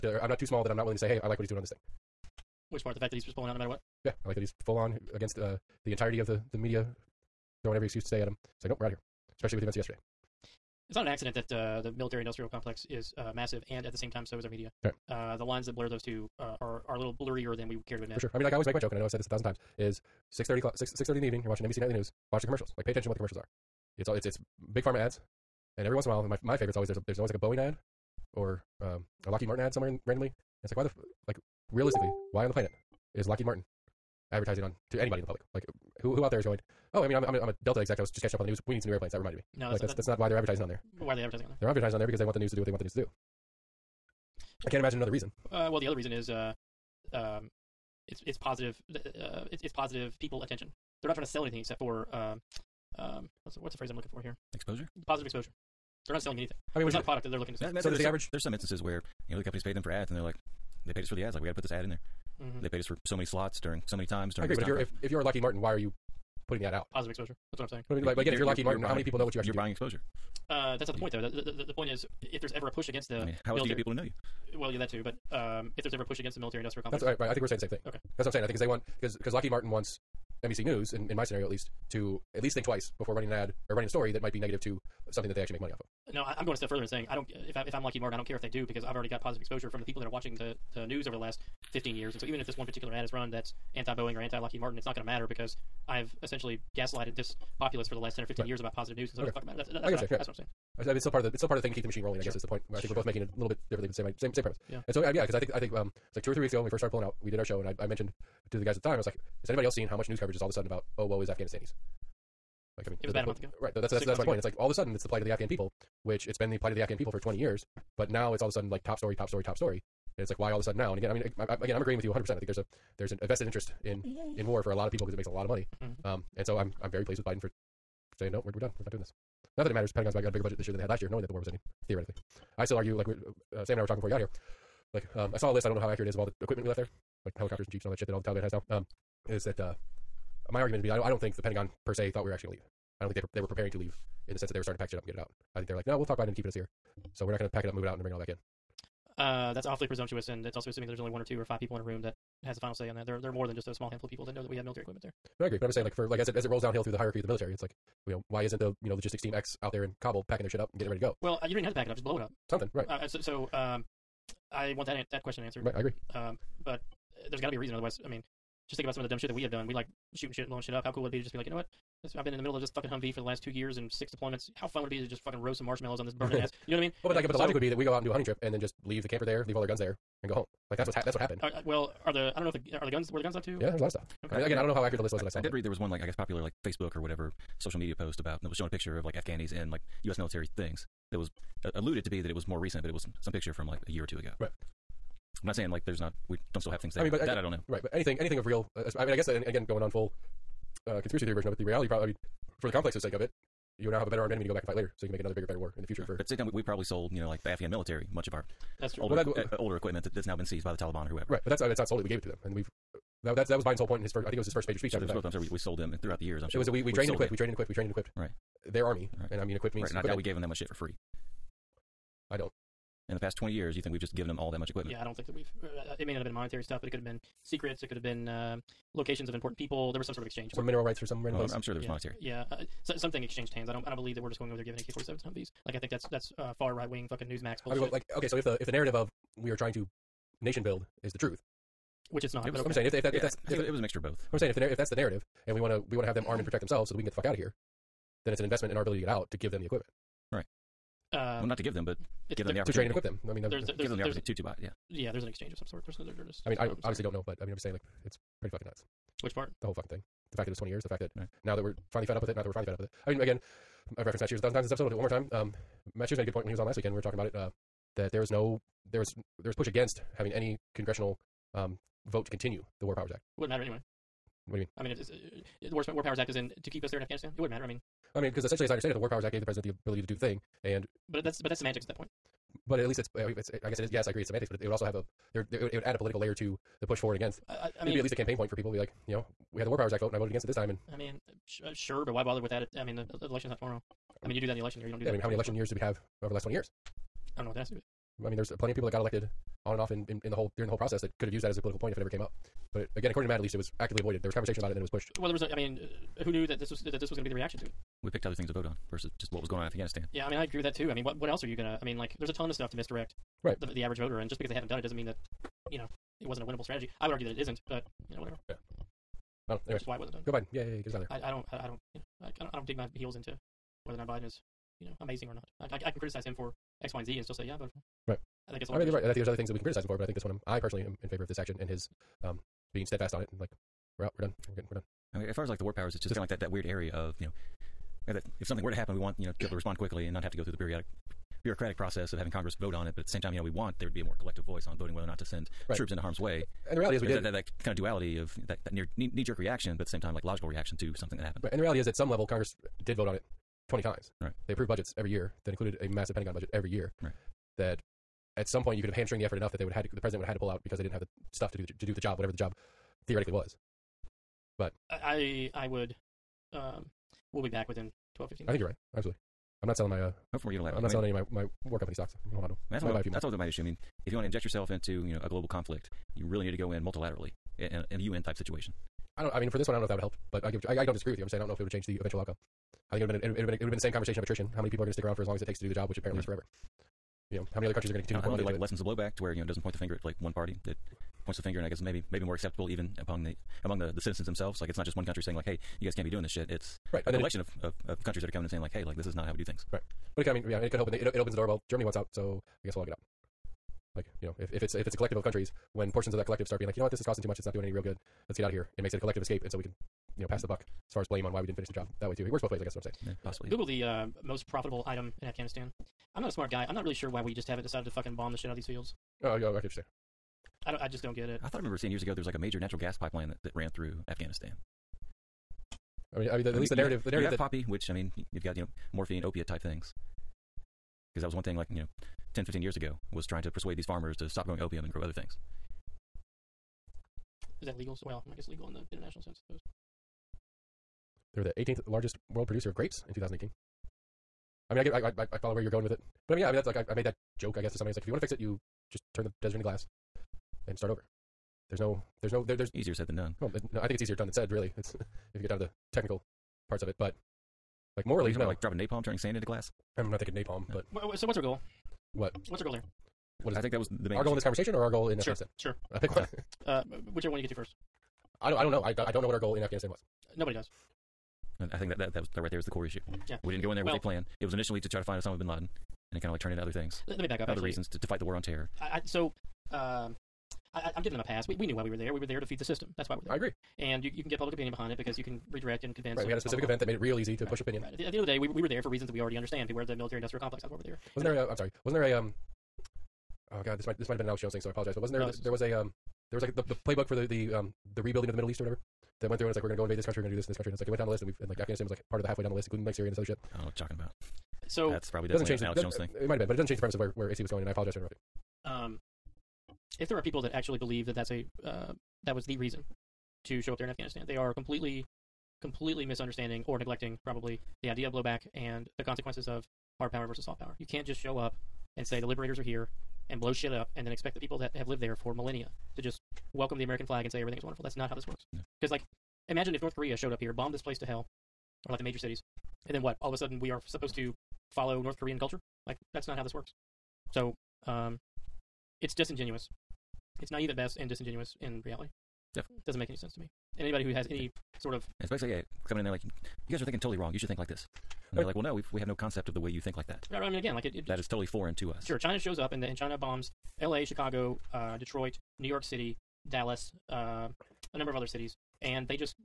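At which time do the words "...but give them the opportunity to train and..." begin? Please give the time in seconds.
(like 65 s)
251 s.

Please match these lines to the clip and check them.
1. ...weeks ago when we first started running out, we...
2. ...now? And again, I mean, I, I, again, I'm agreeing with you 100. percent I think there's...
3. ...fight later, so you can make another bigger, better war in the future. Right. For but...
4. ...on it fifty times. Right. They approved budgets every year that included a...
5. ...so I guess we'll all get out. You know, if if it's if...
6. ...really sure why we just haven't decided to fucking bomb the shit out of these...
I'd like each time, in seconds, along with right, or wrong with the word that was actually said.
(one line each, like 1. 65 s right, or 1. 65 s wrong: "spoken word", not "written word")
1. 106 s wrong: "pulling", not "running"
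2. 120 s right
3. 204 s right
4. 353 s wrong: "twenty", not "fifty"
5. 402 s right
6. 416 s right.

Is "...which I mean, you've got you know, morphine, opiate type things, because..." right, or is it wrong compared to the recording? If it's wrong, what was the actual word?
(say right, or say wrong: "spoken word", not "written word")
right.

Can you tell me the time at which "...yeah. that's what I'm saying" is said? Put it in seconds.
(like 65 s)
100 s.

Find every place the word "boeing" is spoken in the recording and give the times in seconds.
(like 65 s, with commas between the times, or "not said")
27 s, 93 s.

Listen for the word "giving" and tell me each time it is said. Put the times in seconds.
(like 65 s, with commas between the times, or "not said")
234 s, 481 s.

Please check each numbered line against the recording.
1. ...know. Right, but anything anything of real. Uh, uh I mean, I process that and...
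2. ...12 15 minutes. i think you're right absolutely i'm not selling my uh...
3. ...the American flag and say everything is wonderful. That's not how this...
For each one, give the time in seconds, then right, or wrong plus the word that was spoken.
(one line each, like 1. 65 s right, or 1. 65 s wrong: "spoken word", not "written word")
1. 197 s wrong: "guess", not "process"
2. 368 s right
3. 526 s right.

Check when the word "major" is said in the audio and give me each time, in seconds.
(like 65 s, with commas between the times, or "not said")
214 s, 422 s, 532 s.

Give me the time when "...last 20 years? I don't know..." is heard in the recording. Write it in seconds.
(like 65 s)
296 s.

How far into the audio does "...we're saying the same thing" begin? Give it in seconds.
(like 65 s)
77 s.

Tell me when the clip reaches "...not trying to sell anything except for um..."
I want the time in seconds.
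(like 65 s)
51 s.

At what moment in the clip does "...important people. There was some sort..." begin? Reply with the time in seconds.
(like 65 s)
229 s.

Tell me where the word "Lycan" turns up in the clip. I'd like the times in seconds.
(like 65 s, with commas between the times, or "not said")
not said.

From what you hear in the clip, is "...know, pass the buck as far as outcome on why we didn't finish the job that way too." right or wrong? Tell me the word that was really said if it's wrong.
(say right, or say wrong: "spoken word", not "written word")
wrong: "blame", not "outcome".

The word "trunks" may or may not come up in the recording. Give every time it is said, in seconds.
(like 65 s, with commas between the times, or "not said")
not said.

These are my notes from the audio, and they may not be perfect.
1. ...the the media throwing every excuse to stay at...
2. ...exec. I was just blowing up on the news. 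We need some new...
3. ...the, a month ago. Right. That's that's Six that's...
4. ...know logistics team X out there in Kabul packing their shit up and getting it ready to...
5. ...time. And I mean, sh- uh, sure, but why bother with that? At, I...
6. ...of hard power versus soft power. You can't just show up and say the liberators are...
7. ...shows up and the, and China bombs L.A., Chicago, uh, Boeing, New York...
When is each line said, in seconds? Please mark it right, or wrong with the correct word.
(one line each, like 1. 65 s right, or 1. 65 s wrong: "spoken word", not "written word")
1. 6 s right
2. 37 s wrong: "catching", not "blowing"
3. 113 s right
4. 158 s right
5. 290 s right
6. 519 s right
7. 552 s wrong: "Detroit", not "Boeing".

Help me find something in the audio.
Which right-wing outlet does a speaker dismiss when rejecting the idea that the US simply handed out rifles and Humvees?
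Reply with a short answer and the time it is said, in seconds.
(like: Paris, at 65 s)
Newsmax, at 237 s.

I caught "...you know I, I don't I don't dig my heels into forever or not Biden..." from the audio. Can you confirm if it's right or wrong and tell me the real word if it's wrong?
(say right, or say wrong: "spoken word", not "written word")
wrong: "whether", not "forever".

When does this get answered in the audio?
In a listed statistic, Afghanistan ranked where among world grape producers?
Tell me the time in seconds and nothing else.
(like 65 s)
441 s.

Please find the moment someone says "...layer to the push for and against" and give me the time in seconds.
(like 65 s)
286 s.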